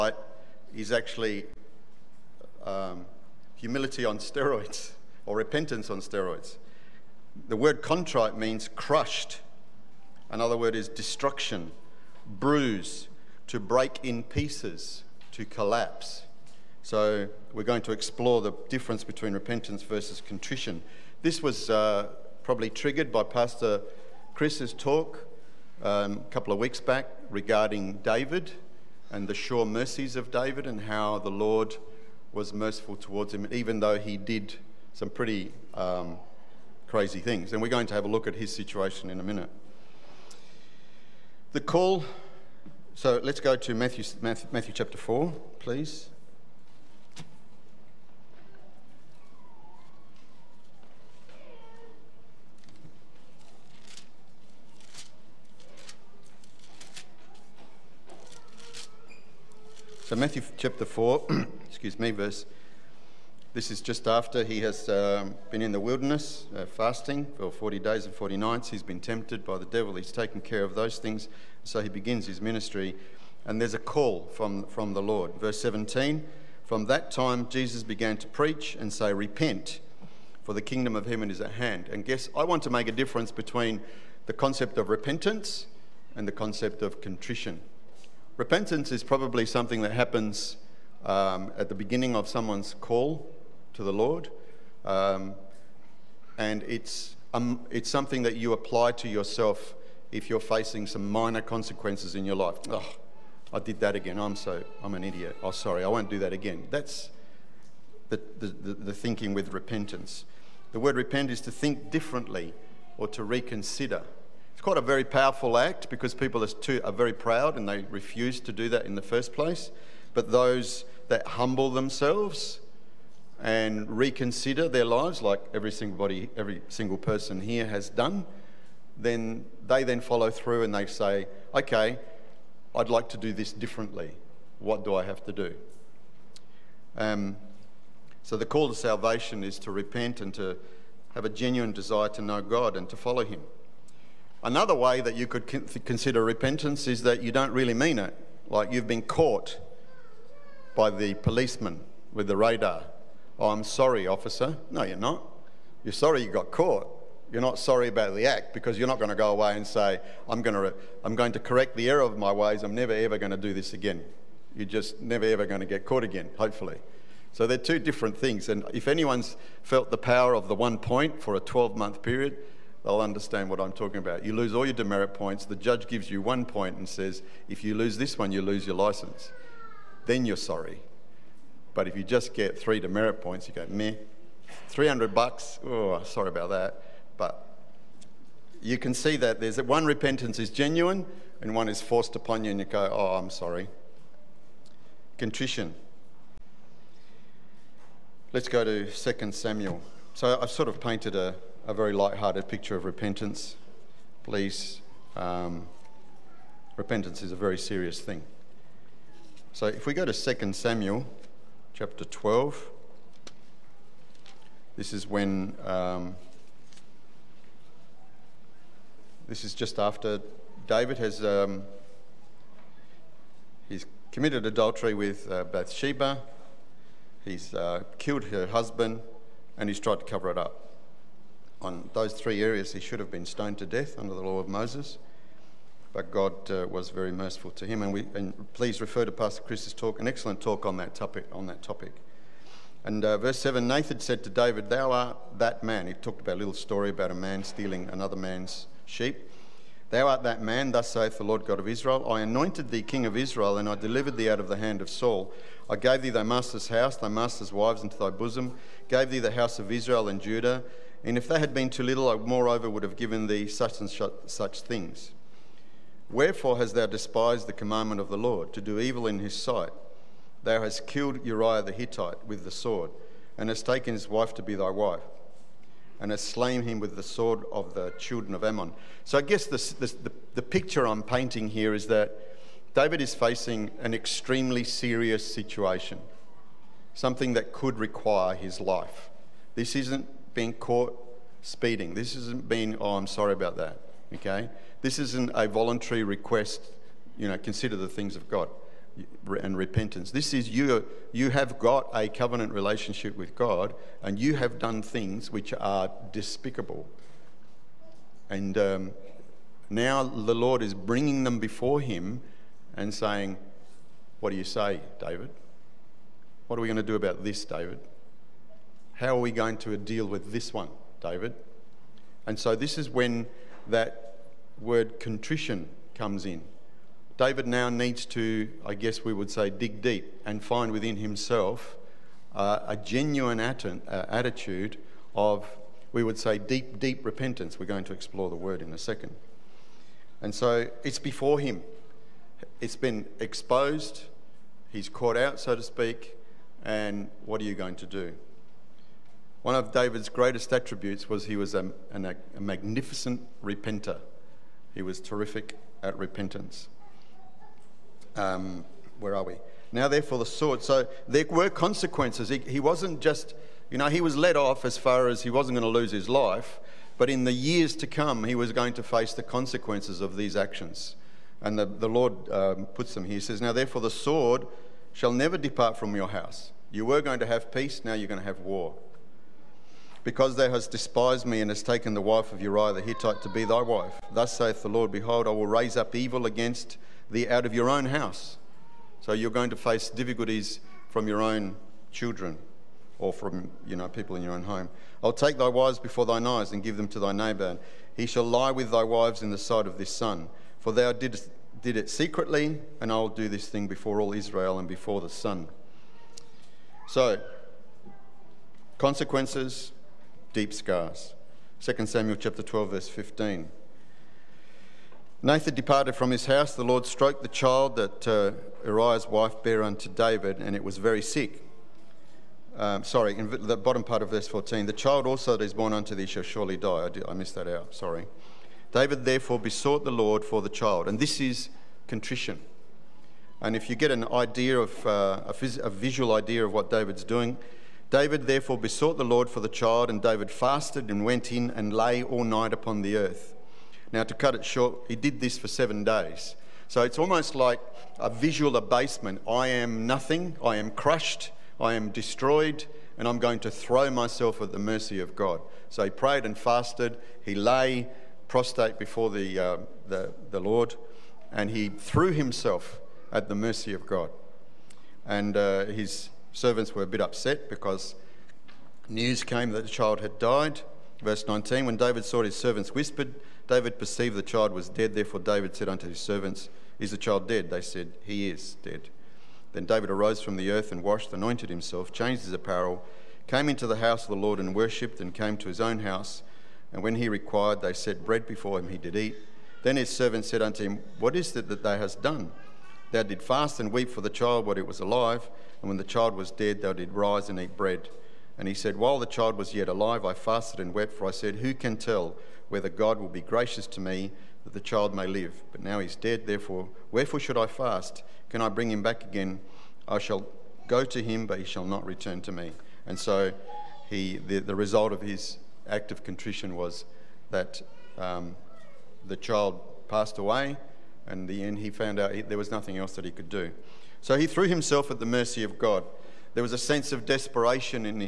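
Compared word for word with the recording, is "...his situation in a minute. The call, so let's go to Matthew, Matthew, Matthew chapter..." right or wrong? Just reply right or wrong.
right.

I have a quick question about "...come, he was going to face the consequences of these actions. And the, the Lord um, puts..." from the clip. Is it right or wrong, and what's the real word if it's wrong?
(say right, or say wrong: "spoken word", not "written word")
right.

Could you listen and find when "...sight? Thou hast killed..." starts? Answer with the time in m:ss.
4:29.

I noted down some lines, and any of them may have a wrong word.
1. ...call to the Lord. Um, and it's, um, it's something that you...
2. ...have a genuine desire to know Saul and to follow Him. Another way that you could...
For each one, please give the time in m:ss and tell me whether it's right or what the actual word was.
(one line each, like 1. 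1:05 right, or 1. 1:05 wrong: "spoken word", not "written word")
1. 1:32 right
2. 2:21 wrong: "God", not "Saul".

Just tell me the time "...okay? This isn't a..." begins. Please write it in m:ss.
4:54.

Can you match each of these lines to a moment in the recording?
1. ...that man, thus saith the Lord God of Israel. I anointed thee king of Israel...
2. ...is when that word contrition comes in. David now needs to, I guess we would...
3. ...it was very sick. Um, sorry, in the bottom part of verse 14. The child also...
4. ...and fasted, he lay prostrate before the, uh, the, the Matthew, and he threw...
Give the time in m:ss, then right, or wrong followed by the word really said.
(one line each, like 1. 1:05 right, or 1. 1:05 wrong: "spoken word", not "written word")
1. 4:10 right
2. 5:22 right
3. 7:00 right
4. 7:36 wrong: "Lord", not "Matthew".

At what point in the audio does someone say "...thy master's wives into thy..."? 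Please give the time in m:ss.
4:16.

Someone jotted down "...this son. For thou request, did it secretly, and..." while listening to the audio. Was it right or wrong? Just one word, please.
wrong.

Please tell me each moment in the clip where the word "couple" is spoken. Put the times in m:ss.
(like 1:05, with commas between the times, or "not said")
0:26.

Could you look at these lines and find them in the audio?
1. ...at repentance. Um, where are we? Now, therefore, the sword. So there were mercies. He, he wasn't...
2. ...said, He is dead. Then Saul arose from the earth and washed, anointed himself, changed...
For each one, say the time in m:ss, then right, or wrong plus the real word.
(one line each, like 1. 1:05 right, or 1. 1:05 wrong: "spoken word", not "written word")
1. 5:55 wrong: "consequences", not "mercies"
2. 7:57 wrong: "David", not "Saul".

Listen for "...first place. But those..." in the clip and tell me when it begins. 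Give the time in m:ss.
1:59.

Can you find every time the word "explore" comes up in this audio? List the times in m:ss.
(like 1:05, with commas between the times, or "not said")
0:17, 5:37.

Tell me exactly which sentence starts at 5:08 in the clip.
And um, now the Lord is bringing them before him and saying, what do you say, David?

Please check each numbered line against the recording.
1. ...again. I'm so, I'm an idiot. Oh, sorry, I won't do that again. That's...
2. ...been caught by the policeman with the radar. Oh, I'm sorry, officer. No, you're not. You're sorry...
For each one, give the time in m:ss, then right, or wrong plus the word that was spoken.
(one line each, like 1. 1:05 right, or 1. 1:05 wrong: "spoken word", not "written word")
1. 1:43 right
2. 2:28 right.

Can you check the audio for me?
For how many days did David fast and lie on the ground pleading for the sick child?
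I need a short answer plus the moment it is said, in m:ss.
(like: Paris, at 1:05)
7, at 7:25.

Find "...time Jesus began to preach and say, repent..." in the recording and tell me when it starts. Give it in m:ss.
1:17.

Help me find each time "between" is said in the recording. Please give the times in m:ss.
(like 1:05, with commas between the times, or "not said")
0:19, 1:23.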